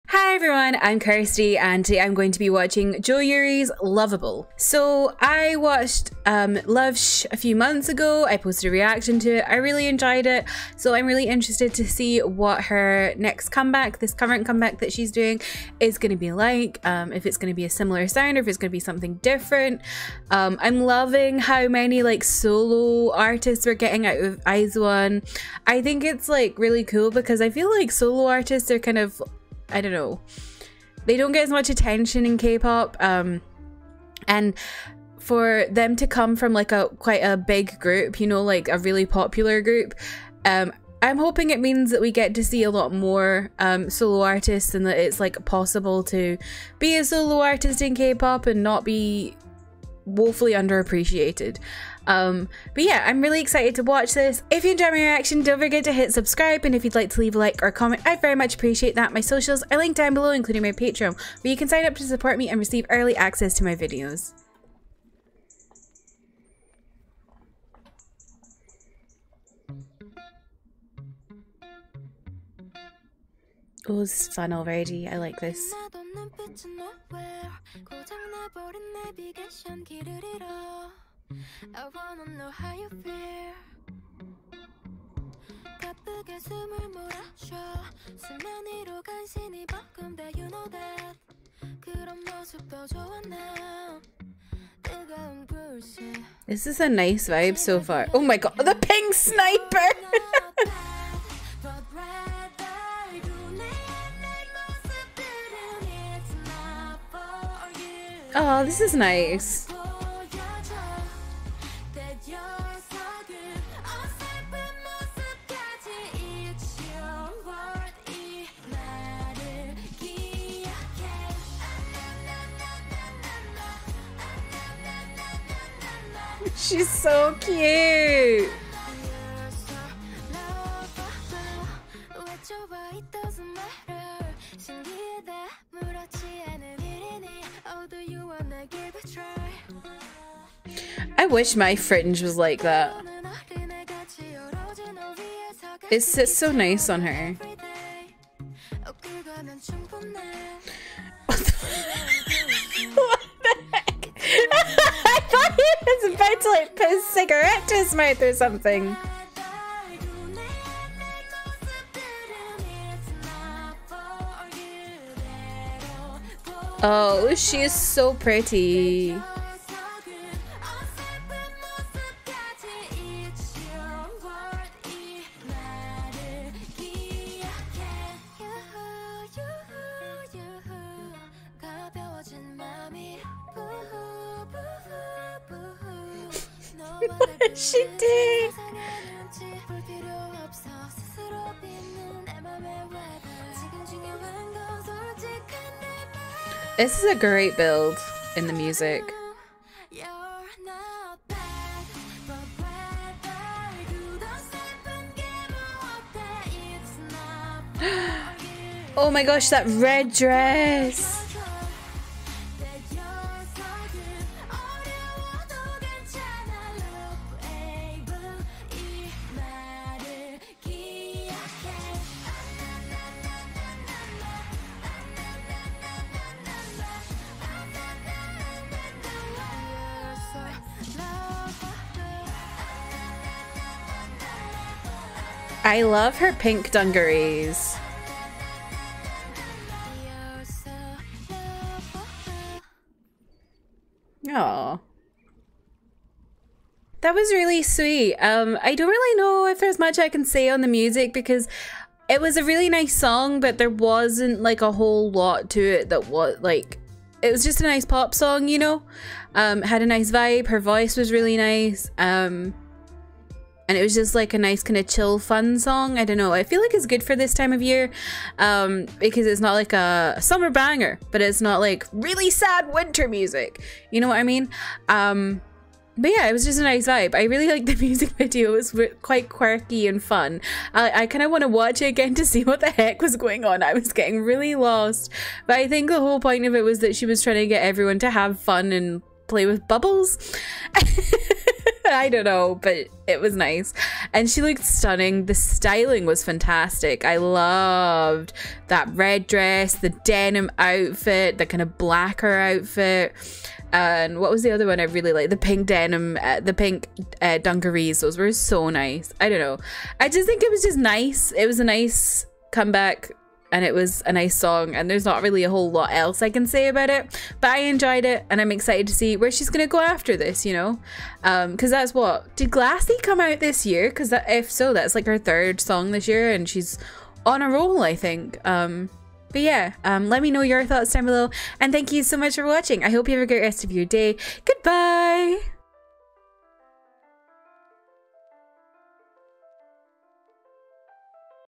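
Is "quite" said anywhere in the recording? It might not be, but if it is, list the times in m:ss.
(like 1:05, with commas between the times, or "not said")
0:36, 4:39.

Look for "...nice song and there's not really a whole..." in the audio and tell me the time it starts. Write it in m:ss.
5:14.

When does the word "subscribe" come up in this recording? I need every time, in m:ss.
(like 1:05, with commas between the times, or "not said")
0:56.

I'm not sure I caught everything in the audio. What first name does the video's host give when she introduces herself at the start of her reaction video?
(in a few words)
Kirsty.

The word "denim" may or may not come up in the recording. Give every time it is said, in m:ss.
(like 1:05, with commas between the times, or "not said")
5:00, 5:05.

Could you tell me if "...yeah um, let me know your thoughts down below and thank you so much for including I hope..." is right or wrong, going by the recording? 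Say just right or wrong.
wrong.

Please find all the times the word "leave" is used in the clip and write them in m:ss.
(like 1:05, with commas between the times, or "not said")
0:57.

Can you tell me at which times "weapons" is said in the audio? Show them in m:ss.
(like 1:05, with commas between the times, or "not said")
not said.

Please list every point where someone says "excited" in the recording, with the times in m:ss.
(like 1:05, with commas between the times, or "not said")
0:53, 5:18.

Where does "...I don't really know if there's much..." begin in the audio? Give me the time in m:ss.
4:08.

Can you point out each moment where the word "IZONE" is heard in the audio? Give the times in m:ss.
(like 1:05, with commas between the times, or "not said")
0:24.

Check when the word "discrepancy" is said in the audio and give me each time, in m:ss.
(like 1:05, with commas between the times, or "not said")
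not said.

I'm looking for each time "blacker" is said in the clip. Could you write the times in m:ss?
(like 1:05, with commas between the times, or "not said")
5:01.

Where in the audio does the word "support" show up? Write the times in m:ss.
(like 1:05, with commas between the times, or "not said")
1:02.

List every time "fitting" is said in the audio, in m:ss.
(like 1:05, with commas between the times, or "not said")
not said.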